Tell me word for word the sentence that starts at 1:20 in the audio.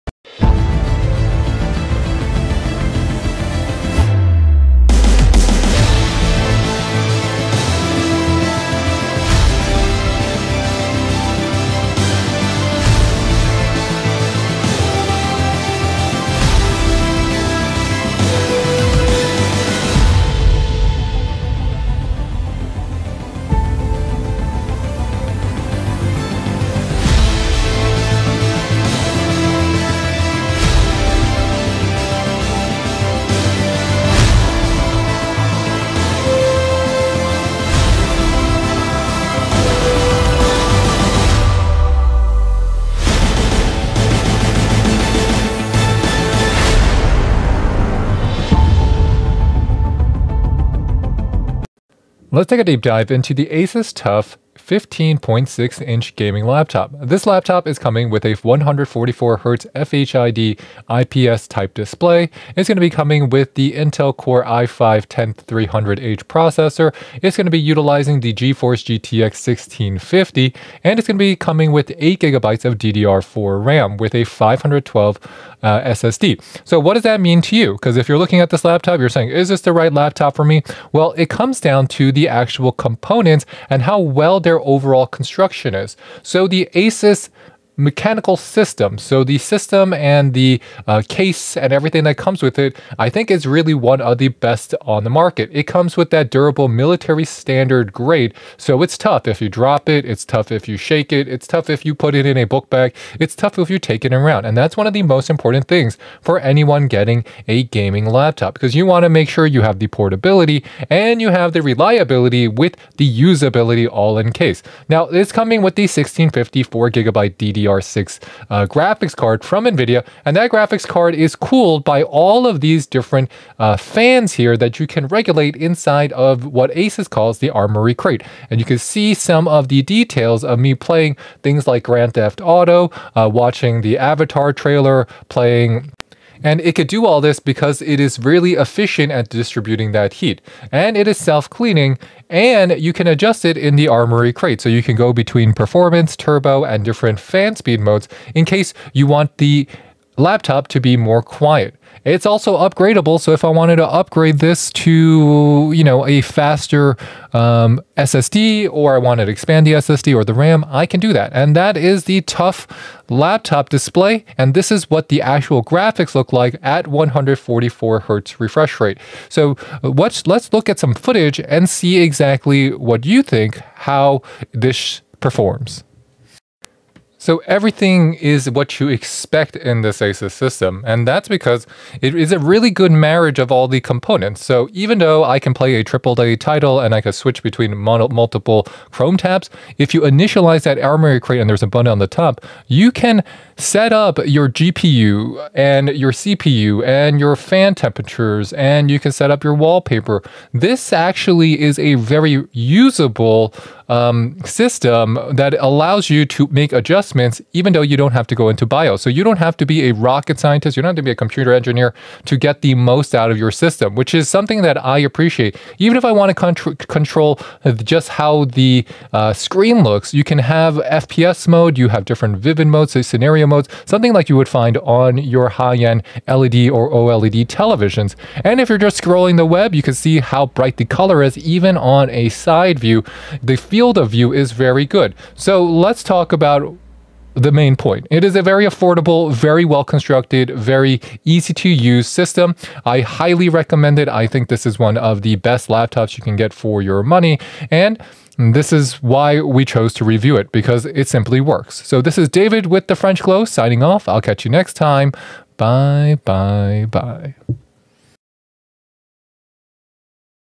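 Well, it comes down to the actual components and how well they're overall construction is.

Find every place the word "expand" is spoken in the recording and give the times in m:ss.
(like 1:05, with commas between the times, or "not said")
2:39.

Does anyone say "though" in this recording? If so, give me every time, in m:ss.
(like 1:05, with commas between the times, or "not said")
3:04, 3:27.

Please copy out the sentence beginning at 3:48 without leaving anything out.
And if you're just scrolling the web, you can see how bright the color is even on a side view.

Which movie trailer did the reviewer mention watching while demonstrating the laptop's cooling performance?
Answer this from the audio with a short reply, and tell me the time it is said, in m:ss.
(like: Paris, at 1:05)
Avatar, at 2:13.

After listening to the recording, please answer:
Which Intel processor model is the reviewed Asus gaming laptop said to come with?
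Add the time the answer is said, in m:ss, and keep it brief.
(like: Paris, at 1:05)
Intel Core i5-10300H, at 1:03.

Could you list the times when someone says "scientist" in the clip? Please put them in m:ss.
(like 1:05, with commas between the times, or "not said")
3:30.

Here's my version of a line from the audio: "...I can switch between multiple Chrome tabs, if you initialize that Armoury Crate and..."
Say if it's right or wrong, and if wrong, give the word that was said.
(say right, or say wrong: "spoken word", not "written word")
right.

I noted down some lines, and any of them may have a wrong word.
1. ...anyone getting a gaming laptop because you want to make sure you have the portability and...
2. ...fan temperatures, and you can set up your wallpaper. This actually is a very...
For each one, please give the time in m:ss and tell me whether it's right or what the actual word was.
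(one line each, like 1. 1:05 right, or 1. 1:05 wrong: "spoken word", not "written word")
1. 1:46 right
2. 3:17 right.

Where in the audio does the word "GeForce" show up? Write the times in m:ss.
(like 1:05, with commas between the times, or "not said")
1:08.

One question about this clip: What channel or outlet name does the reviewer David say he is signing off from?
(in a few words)
French Glow.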